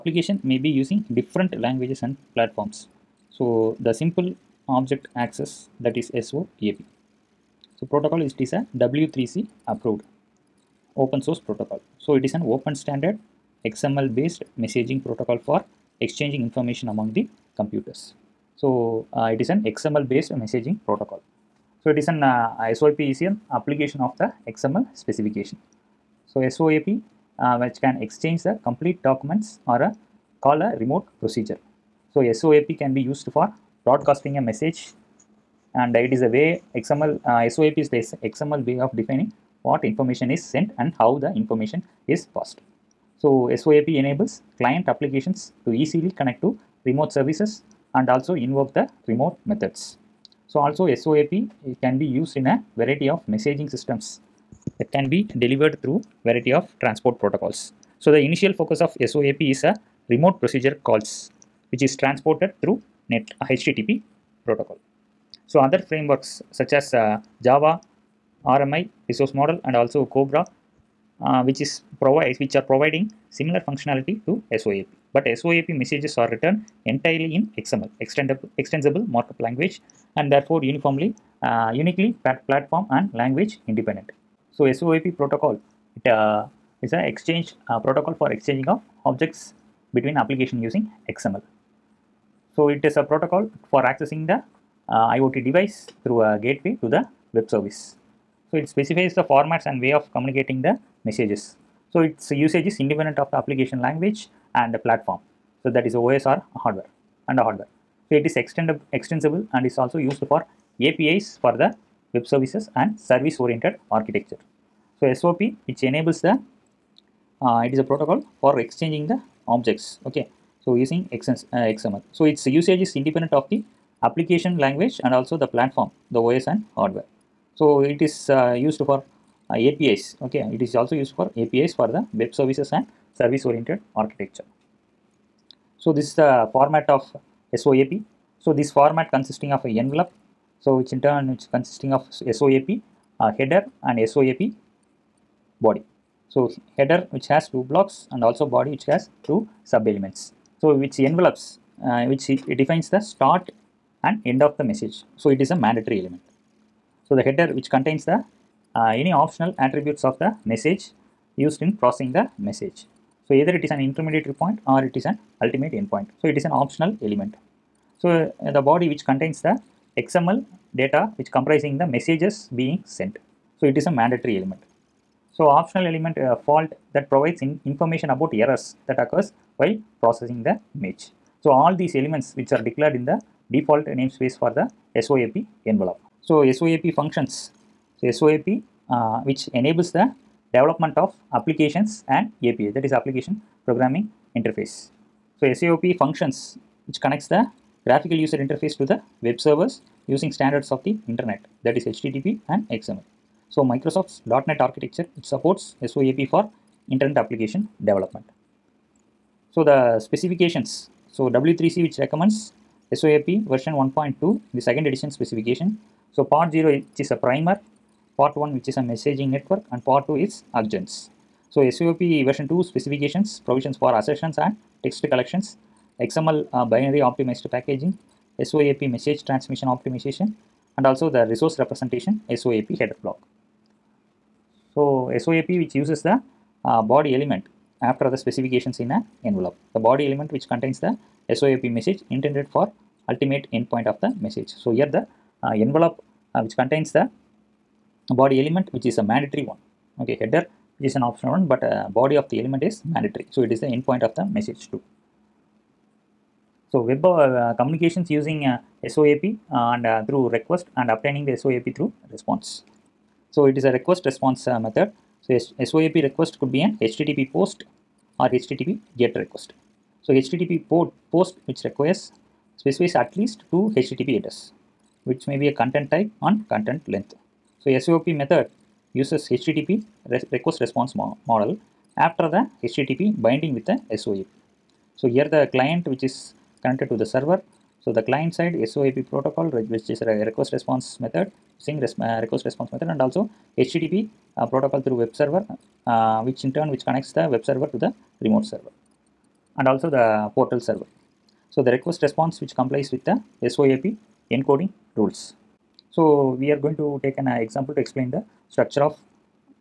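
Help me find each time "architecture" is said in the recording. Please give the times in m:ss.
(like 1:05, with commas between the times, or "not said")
1:53, 2:14, 3:24.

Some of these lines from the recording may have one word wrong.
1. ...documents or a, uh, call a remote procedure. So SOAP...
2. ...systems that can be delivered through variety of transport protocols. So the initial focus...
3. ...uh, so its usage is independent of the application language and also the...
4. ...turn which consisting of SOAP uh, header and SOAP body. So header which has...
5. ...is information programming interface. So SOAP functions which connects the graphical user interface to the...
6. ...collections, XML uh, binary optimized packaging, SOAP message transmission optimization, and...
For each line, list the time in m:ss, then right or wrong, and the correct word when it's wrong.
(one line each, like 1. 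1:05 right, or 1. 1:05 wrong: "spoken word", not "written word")
1. 0:29 right
2. 0:53 right
3. 2:01 right
4. 2:21 right
5. 3:12 wrong: "application", not "information"
6. 3:45 right.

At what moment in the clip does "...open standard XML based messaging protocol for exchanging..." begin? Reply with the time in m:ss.
0:12.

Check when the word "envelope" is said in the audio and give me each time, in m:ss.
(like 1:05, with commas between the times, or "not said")
2:19, 2:30, 3:05, 3:59, 4:05.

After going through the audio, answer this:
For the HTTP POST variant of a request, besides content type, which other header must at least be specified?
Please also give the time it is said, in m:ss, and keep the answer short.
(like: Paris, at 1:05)
Content length, at 4:36.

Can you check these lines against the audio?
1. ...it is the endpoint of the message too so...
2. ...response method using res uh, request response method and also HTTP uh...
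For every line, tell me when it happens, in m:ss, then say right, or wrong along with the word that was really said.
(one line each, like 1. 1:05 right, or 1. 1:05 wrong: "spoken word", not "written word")
1. 4:13 right
2. 4:50 right.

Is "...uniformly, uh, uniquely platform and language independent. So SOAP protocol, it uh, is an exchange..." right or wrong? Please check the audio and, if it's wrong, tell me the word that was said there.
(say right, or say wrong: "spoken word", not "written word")
right.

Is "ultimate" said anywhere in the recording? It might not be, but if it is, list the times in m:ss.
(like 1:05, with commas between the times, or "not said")
2:45, 4:03.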